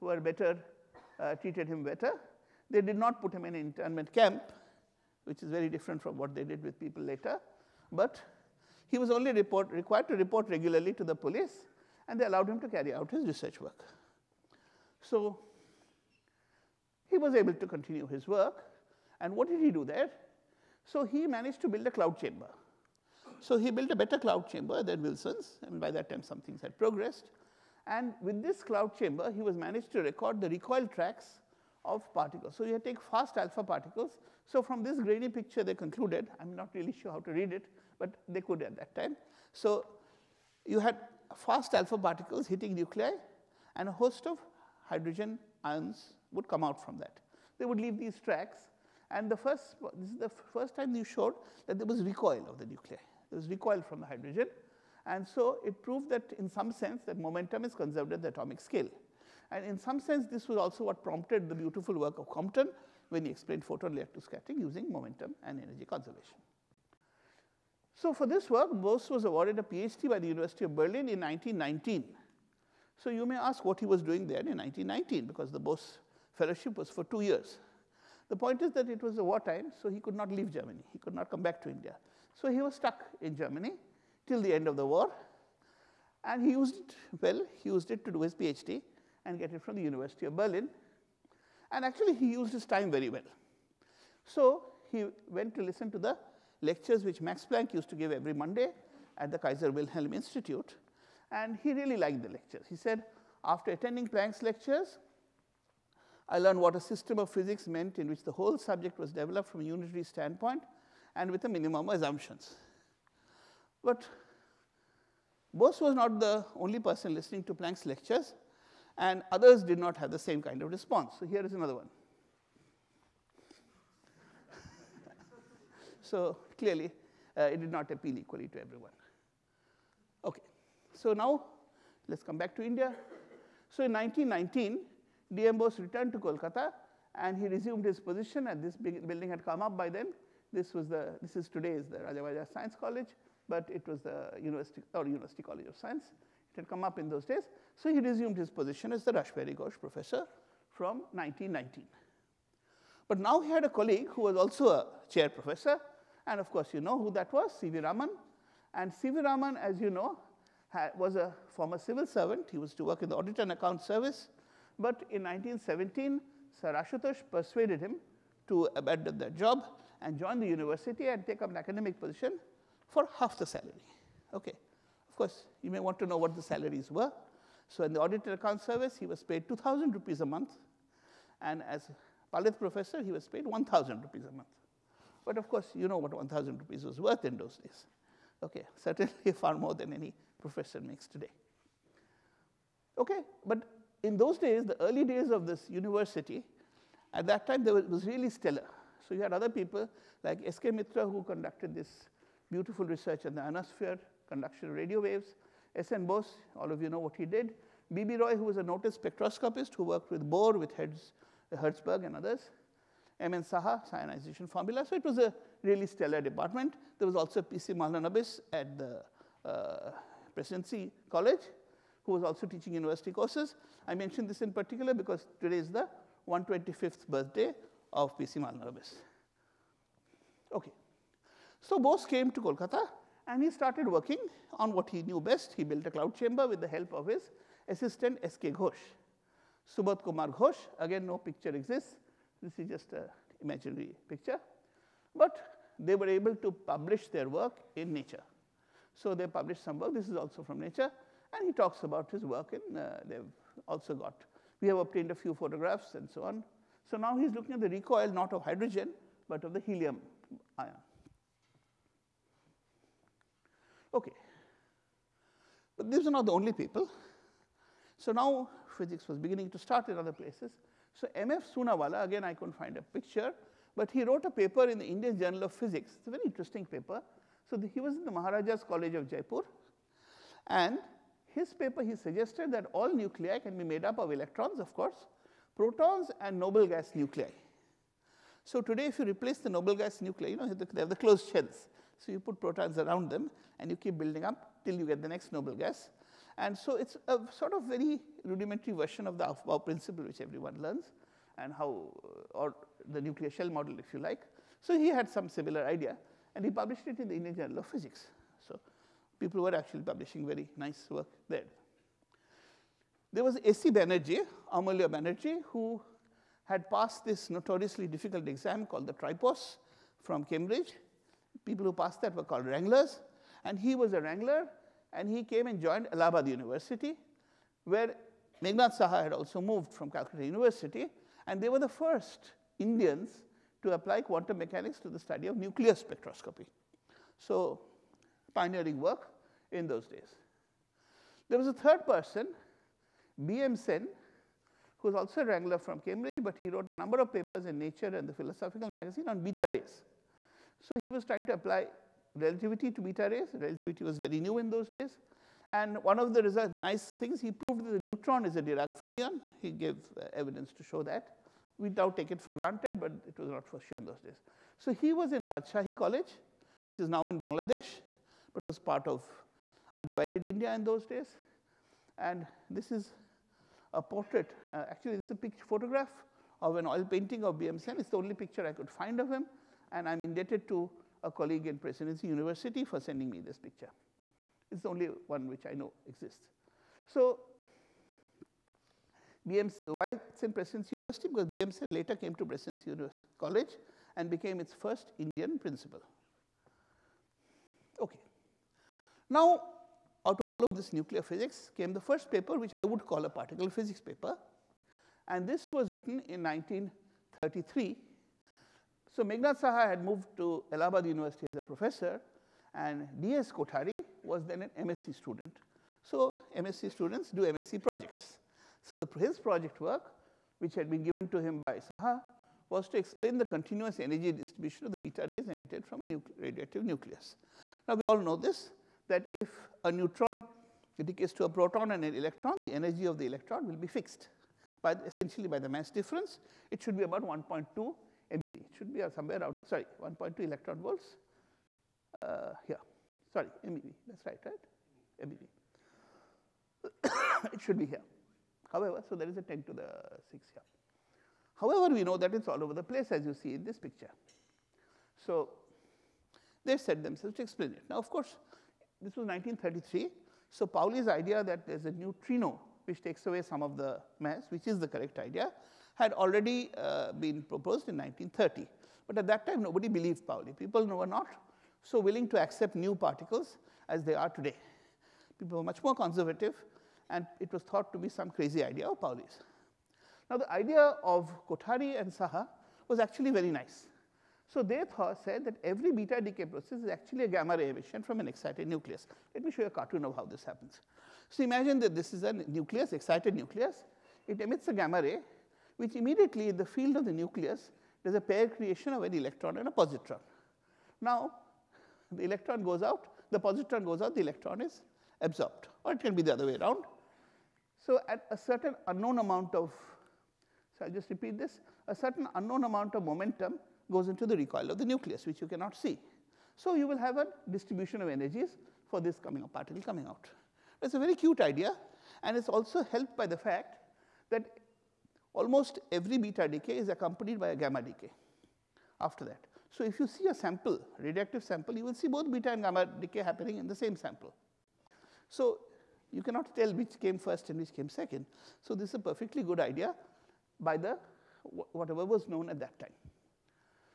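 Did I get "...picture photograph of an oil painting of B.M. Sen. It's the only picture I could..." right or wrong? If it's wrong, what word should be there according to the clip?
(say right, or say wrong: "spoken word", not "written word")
right.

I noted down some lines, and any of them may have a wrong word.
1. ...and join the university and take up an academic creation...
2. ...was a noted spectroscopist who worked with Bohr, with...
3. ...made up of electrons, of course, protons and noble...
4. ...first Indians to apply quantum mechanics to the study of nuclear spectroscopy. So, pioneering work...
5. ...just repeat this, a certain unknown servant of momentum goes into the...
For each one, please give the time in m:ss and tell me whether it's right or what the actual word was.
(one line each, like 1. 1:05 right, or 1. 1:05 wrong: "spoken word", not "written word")
1. 2:50 wrong: "position", not "creation"
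2. 3:28 right
3. 4:43 right
4. 5:31 right
5. 8:30 wrong: "amount", not "servant".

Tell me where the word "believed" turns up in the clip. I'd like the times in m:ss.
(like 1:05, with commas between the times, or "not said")
7:49.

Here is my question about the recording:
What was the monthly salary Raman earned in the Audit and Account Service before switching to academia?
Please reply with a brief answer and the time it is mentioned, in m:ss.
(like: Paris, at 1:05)
2,000 rupees, at 2:59.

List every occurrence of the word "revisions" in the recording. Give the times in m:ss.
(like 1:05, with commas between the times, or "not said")
not said.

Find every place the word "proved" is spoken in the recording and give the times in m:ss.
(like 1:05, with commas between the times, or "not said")
0:55, 5:57.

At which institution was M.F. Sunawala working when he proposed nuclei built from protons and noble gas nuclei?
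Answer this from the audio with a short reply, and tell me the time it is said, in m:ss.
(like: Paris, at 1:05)
Maharaja's College of Jaipur, at 4:38.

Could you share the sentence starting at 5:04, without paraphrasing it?
So he had some similar idea and he published it in the Indian Journal of Physics.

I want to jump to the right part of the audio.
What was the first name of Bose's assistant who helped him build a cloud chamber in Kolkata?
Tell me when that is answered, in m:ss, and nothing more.
3:59.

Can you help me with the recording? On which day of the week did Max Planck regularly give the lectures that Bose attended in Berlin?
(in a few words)
Monday.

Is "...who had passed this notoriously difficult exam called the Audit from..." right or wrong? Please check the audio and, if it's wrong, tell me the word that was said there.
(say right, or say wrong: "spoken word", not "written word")
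wrong: "TRIPOS", not "Audit".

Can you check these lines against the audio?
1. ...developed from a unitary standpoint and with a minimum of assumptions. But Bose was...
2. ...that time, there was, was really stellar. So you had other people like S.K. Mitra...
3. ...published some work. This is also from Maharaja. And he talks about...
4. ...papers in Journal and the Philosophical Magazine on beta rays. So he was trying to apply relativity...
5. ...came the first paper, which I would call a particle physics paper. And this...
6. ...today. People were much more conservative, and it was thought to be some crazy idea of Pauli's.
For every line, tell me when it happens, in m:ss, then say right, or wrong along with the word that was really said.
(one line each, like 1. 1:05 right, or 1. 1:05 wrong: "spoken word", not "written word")
1. 1:49 right
2. 3:17 right
3. 4:09 wrong: "Nature", not "Maharaja"
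4. 5:47 wrong: "Nature", not "Journal"
5. 6:41 right
6. 7:54 right.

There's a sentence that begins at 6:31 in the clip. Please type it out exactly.
Because BM Sen later came to Presidency University College and became its first Indian principal.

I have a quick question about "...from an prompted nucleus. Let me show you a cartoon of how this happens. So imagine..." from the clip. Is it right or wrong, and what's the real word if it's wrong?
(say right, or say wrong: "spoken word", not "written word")
wrong: "excited", not "prompted".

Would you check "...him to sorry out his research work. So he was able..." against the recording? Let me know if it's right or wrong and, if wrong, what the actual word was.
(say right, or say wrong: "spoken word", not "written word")
wrong: "carry", not "sorry".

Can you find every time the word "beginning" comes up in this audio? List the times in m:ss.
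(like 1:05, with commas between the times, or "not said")
4:29.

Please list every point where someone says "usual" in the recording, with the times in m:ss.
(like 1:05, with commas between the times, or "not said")
not said.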